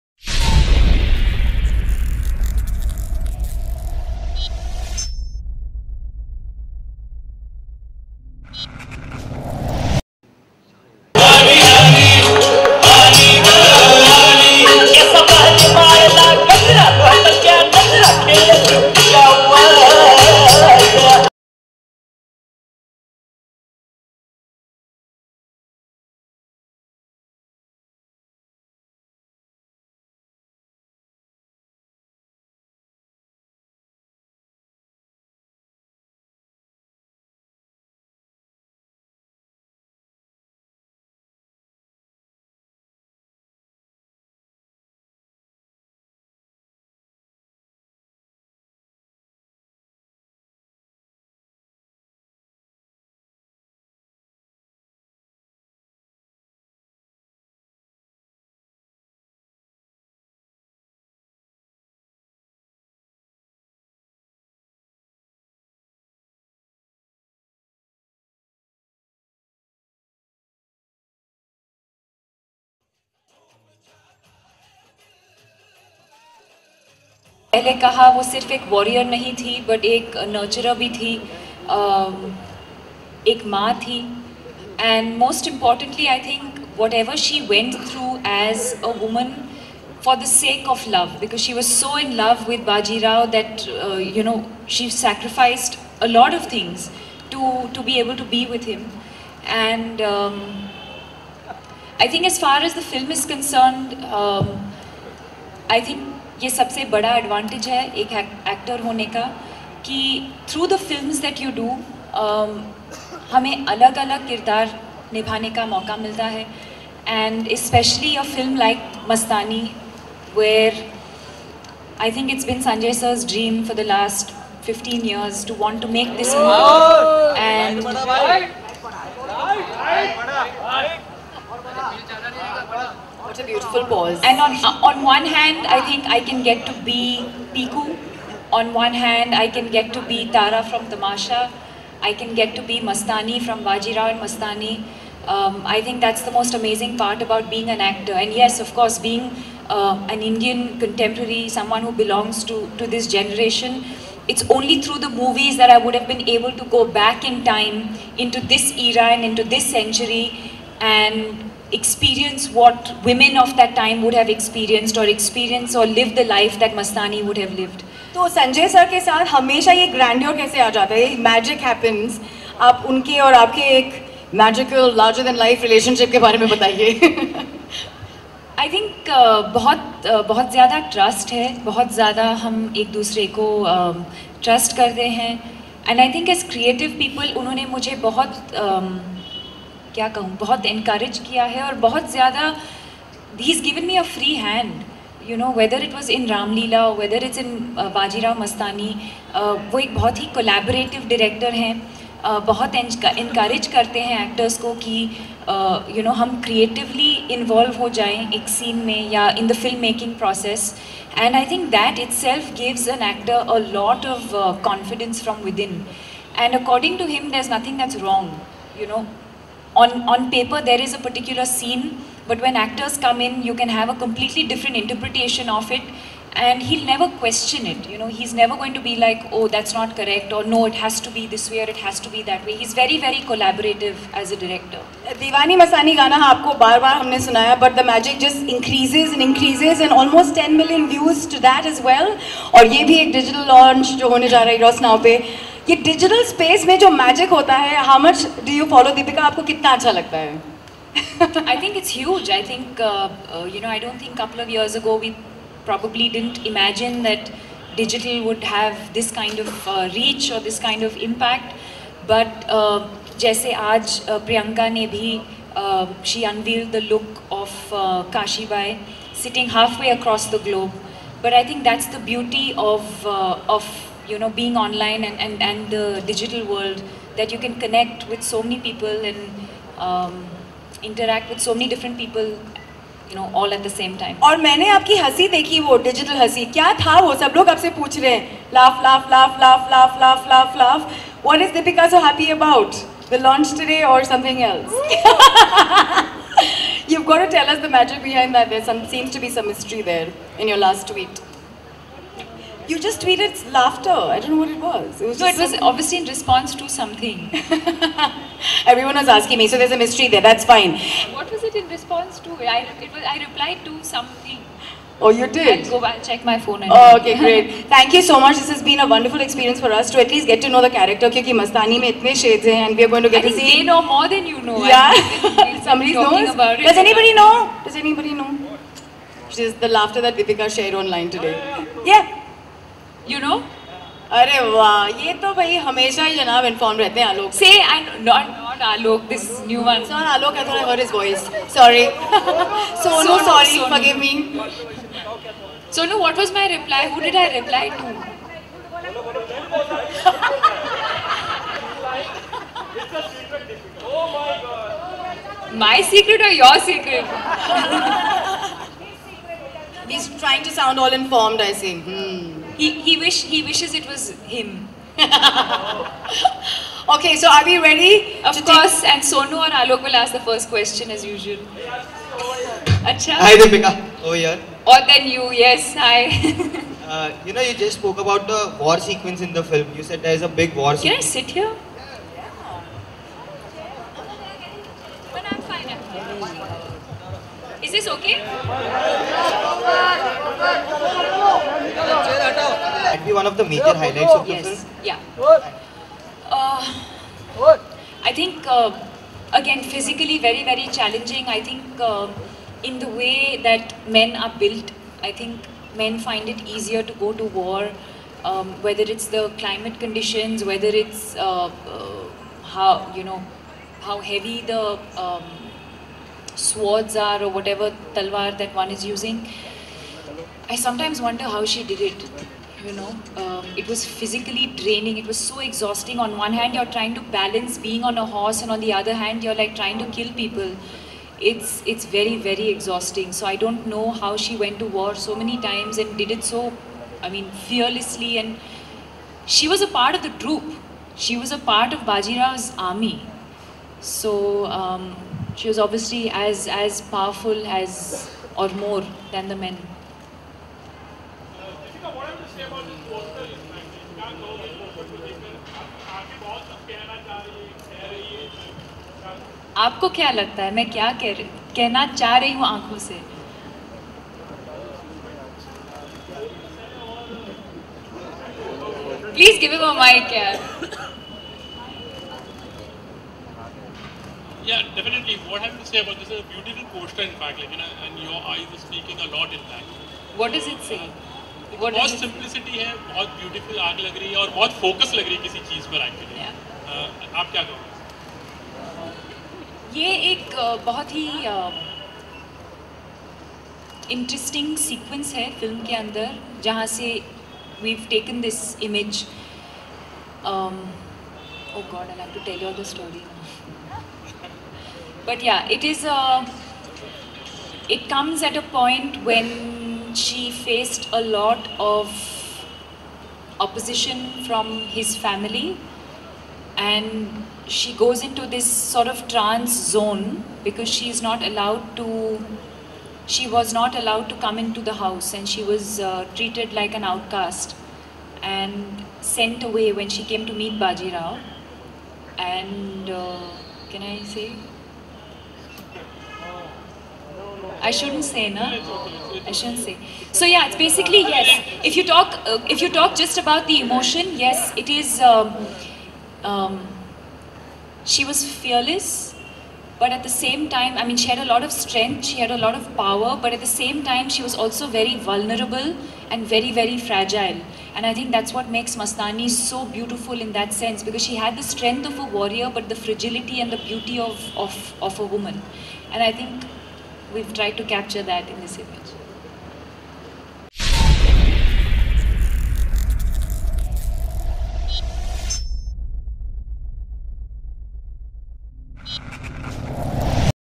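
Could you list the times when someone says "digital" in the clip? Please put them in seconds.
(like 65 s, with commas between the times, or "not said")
243 s, 276 s.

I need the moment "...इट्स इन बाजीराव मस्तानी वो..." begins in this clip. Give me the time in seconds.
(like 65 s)
197 s.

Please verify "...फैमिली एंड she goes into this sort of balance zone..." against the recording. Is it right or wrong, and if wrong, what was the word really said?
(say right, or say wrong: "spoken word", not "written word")
wrong: "trance", not "balance".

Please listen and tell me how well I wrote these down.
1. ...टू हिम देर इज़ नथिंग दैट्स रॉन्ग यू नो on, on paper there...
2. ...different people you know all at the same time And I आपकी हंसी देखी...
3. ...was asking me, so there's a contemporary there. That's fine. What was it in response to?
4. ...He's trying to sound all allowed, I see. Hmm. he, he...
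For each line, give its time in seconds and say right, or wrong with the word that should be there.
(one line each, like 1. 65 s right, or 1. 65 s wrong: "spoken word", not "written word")
1. 216 s right
2. 281 s right
3. 308 s wrong: "mystery", not "contemporary"
4. 359 s wrong: "informed", not "allowed".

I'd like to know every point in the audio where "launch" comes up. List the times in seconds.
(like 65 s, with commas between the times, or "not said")
243 s, 293 s.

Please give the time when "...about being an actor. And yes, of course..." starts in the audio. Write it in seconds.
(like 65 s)
147 s.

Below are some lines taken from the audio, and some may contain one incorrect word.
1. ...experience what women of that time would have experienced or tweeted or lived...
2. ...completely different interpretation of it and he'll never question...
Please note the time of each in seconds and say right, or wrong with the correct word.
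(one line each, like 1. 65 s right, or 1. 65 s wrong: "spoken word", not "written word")
1. 161 s wrong: "experienced", not "tweeted"
2. 223 s right.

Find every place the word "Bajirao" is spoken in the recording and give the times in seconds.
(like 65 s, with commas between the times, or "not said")
143 s, 441 s, 530 s.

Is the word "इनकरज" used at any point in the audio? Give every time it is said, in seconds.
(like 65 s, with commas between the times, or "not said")
190 s, 203 s.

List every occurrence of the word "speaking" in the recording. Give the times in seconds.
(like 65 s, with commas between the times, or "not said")
478 s.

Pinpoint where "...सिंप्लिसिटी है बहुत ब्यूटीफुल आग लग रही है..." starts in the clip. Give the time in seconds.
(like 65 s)
482 s.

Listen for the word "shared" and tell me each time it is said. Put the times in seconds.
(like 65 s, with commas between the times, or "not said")
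330 s.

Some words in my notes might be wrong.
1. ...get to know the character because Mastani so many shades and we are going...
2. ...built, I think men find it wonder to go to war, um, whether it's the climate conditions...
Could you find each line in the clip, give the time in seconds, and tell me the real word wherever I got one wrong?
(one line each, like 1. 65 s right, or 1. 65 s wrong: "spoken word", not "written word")
1. 320 s right
2. 404 s wrong: "easier", not "wonder".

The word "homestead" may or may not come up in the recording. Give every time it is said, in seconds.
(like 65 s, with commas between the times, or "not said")
not said.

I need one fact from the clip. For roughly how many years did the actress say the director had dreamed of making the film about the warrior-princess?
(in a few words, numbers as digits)
15 years.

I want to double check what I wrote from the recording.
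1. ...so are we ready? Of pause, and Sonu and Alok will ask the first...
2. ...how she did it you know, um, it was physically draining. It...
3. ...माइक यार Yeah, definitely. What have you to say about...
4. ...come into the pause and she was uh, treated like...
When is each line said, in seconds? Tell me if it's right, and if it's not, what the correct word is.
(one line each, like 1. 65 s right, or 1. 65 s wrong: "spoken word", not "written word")
1. 367 s wrong: "course", not "pause"
2. 421 s right
3. 469 s right
4. 524 s wrong: "house", not "pause".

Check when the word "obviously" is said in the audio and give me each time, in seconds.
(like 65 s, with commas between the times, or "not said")
305 s, 445 s.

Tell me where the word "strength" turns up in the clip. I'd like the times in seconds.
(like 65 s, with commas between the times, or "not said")
551 s, 561 s.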